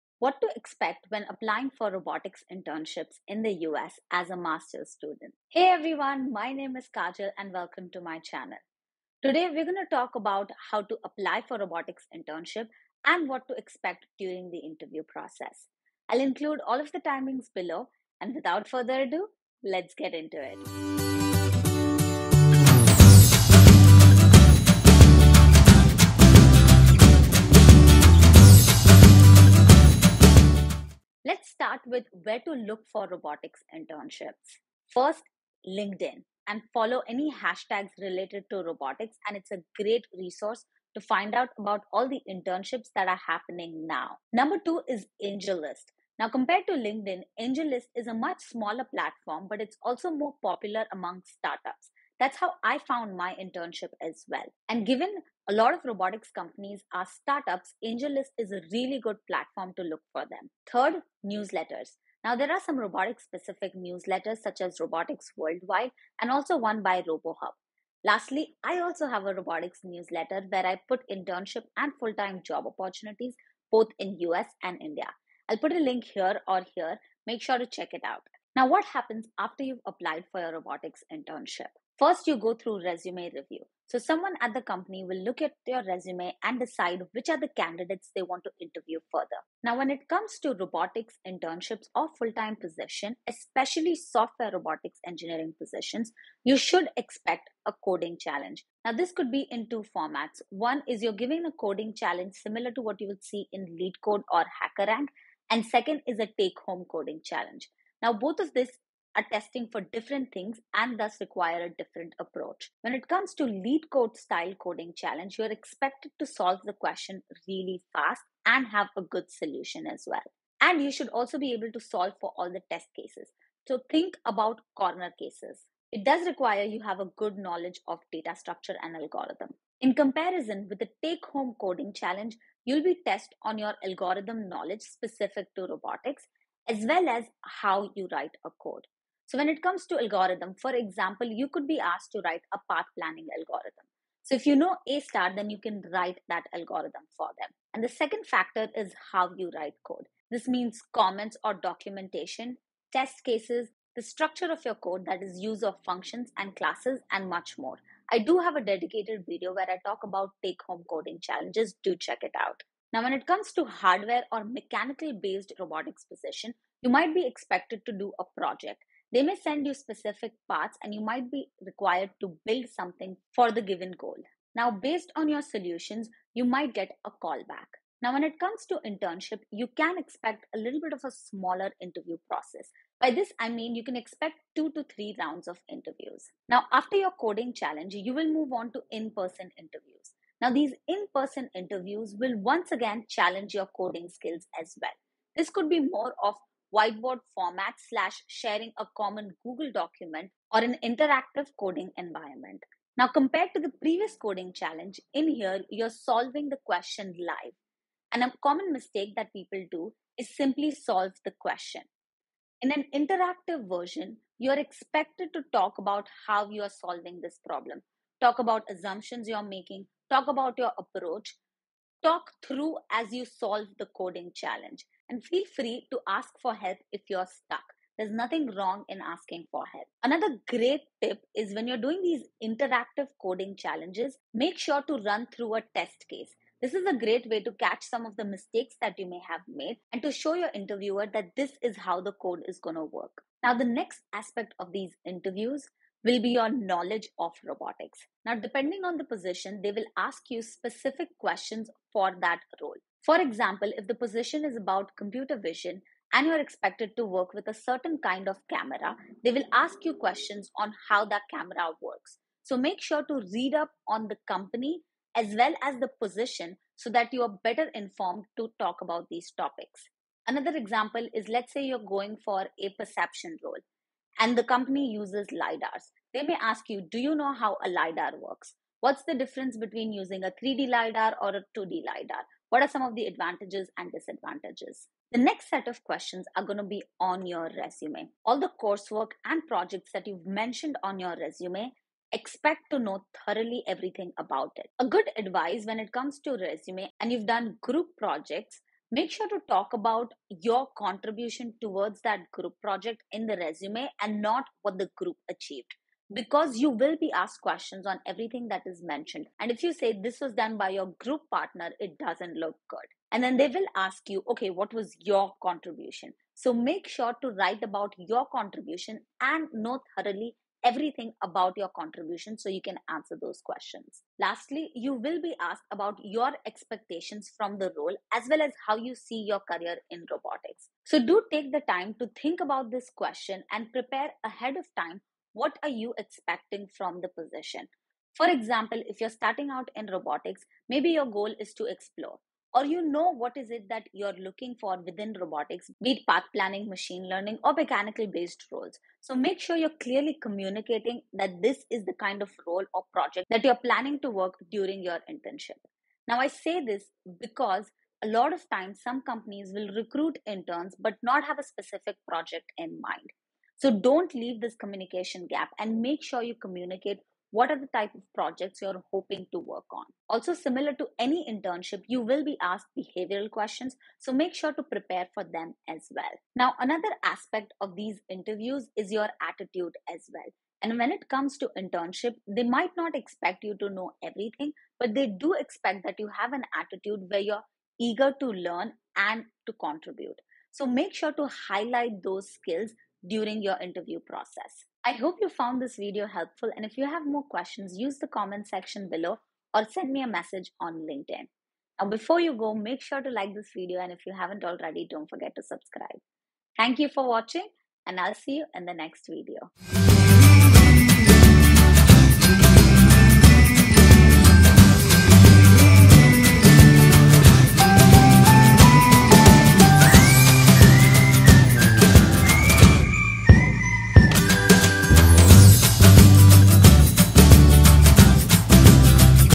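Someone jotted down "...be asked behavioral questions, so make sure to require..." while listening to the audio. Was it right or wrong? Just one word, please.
wrong.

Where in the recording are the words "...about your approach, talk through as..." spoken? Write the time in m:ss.
3:40.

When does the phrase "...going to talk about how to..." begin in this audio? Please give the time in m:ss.
0:09.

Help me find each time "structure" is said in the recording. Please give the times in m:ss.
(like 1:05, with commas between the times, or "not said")
2:08, 2:34.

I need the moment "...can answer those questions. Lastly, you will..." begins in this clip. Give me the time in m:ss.
5:22.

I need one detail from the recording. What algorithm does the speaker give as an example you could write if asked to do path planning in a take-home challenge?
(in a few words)
A star.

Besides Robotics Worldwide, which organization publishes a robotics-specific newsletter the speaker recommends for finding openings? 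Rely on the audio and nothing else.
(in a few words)
RoboHub.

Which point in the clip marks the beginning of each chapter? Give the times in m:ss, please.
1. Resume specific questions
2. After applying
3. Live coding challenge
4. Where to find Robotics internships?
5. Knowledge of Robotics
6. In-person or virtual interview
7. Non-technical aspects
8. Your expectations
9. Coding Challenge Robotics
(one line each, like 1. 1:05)
1. 4:44
2. 1:18
3. 3:22
4. 0:30
5. 4:03
6. 3:06
7. 6:09
8. 5:24
9. 1:29.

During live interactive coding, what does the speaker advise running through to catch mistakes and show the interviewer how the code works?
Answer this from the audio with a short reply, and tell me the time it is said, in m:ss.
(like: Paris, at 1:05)
A test case, at 3:55.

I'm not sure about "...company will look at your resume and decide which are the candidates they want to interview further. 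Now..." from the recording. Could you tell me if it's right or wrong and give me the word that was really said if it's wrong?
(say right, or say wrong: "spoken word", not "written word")
right.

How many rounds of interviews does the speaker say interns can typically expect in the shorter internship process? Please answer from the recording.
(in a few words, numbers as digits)
2 to 3.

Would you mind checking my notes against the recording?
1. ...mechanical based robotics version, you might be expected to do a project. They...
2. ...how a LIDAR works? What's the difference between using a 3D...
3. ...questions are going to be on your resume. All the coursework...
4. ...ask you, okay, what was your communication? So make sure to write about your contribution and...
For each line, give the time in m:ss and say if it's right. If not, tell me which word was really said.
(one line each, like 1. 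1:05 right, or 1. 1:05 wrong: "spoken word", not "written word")
1. 2:44 wrong: "position", not "version"
2. 4:37 right
3. 4:45 right
4. 5:13 wrong: "contribution", not "communication".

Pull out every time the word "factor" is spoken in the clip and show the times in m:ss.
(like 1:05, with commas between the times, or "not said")
2:28.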